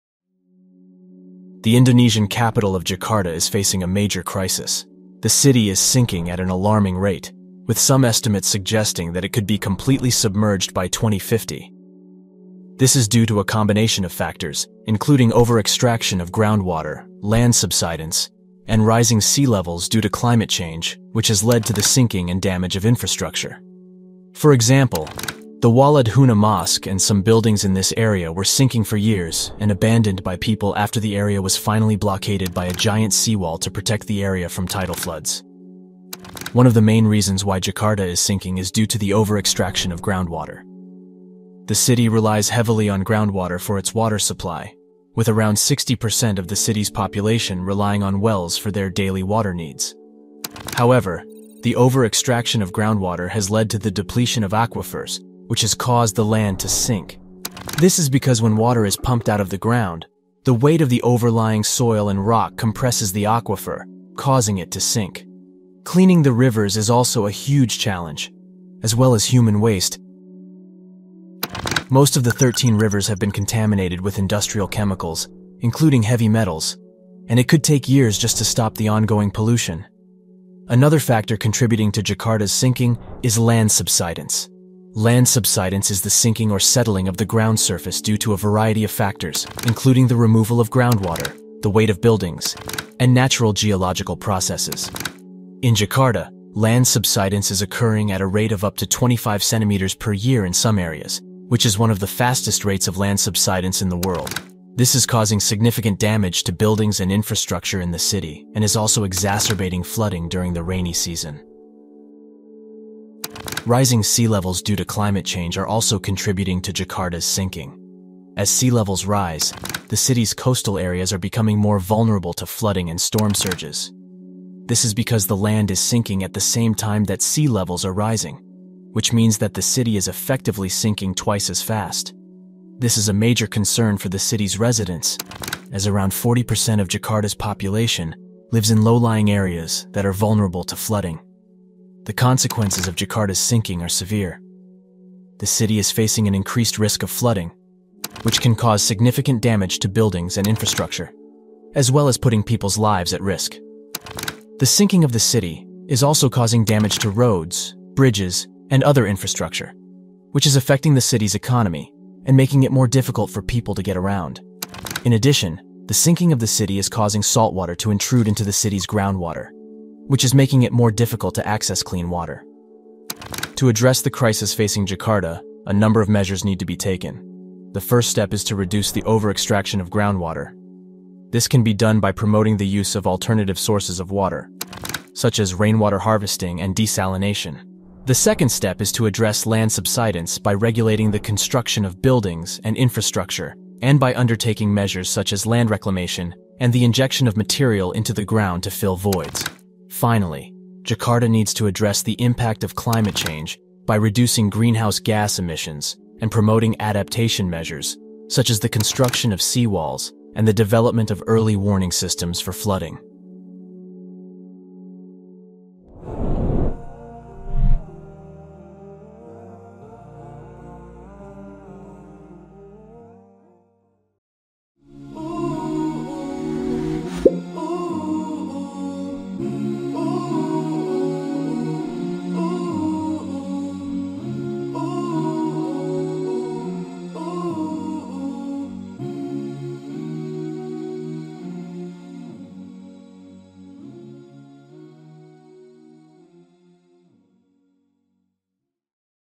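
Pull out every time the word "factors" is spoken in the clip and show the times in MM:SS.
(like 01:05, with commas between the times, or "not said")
00:14, 01:21, 01:28.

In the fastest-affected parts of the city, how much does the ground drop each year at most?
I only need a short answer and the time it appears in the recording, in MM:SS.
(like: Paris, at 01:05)
25 centimeters, at 01:38.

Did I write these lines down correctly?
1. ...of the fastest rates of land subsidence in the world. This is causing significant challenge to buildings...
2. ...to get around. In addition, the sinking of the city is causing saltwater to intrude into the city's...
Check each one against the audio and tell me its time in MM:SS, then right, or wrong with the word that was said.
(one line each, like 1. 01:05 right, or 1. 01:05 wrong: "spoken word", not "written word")
1. 01:41 wrong: "damage", not "challenge"
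2. 02:43 right.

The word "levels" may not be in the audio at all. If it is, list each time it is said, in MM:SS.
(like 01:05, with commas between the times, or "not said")
00:19, 01:54, 01:58, 02:07.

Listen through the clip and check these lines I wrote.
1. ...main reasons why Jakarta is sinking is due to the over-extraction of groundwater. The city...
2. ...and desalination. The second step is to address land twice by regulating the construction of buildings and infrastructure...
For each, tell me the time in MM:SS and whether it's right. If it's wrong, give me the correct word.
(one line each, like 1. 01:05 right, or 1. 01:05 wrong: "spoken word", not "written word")
1. 00:36 right
2. 03:06 wrong: "subsidence", not "twice".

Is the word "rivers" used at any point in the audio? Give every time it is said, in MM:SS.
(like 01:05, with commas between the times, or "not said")
01:06, 01:12.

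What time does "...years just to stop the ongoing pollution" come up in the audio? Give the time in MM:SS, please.
01:17.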